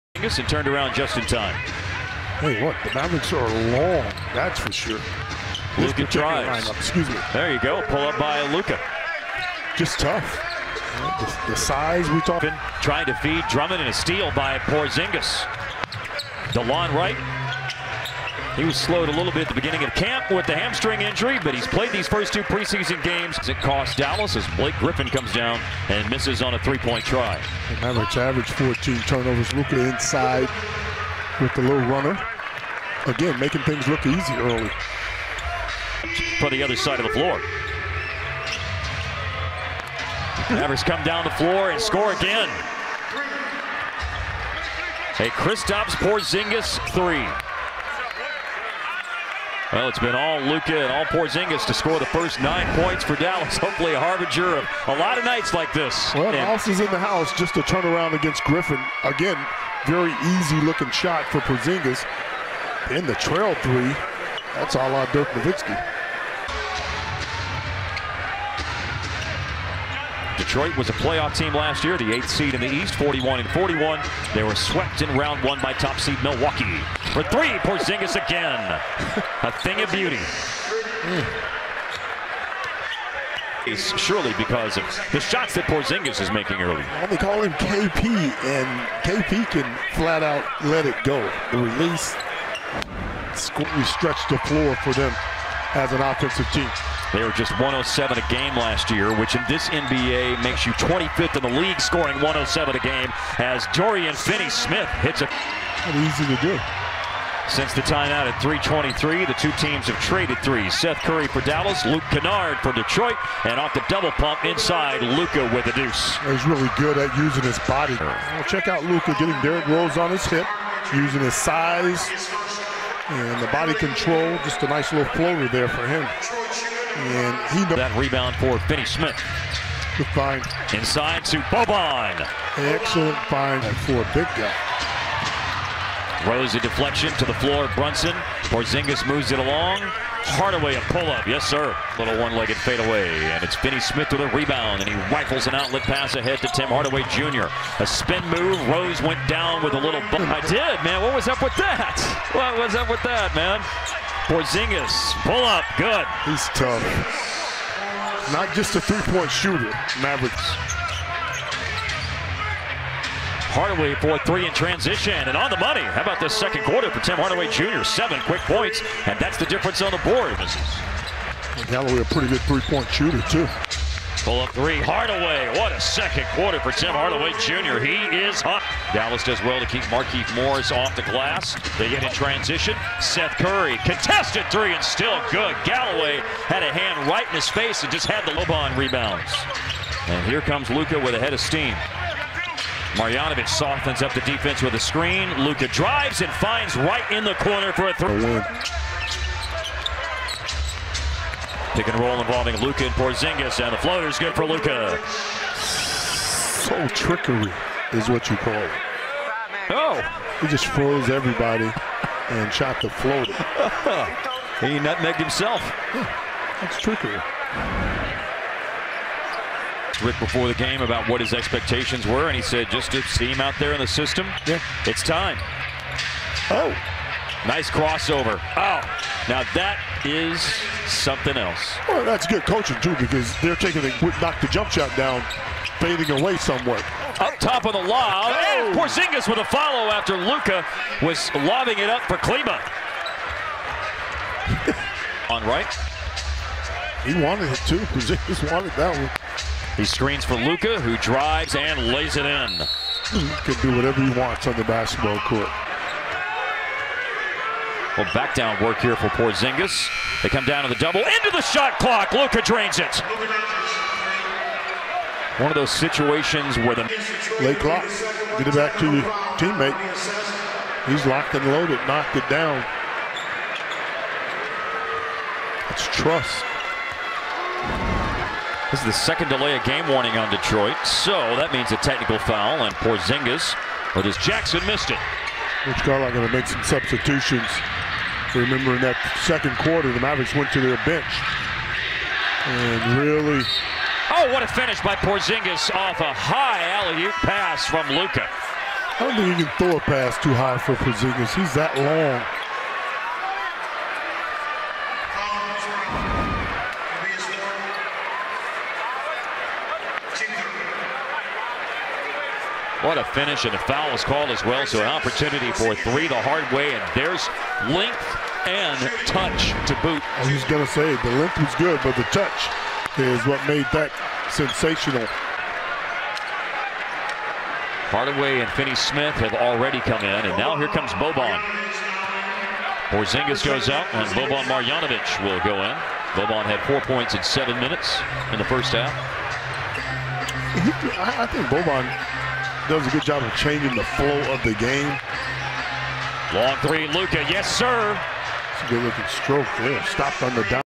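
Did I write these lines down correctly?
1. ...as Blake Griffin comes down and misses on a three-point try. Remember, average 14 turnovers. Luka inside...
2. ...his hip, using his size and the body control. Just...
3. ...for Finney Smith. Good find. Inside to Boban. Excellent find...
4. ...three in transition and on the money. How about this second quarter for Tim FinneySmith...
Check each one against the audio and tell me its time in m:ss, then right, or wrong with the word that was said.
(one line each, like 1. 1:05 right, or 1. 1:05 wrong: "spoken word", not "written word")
1. 0:24 right
2. 2:00 right
3. 2:08 right
4. 2:44 wrong: "Hardaway", not "FinneySmith".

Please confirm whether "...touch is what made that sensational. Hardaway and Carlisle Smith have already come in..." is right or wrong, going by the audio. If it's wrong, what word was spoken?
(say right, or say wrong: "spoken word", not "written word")
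wrong: "Finney", not "Carlisle".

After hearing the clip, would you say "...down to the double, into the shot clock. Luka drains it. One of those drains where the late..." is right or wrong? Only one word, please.
wrong.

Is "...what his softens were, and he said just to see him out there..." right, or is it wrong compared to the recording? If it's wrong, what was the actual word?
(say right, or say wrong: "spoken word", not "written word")
wrong: "expectations", not "softens".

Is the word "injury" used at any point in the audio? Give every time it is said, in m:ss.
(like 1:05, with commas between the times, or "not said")
0:21.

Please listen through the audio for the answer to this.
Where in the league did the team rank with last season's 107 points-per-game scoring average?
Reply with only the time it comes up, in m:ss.
1:40.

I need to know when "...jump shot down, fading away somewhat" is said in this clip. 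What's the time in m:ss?
3:54.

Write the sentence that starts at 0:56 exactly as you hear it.
Well, Dallas is in the house just to turn around against Griffin.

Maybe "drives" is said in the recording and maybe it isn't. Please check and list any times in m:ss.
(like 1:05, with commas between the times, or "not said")
0:06, 3:15, 4:10.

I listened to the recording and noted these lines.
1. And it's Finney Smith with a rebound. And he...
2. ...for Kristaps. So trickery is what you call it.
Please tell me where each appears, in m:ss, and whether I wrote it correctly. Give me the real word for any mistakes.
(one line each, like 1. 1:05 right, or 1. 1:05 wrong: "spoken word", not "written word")
1. 2:23 right
2. 3:24 wrong: "Luka", not "Kristaps".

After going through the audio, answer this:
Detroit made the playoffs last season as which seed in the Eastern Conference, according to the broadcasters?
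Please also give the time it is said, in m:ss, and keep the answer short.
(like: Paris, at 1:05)
8th, at 1:12.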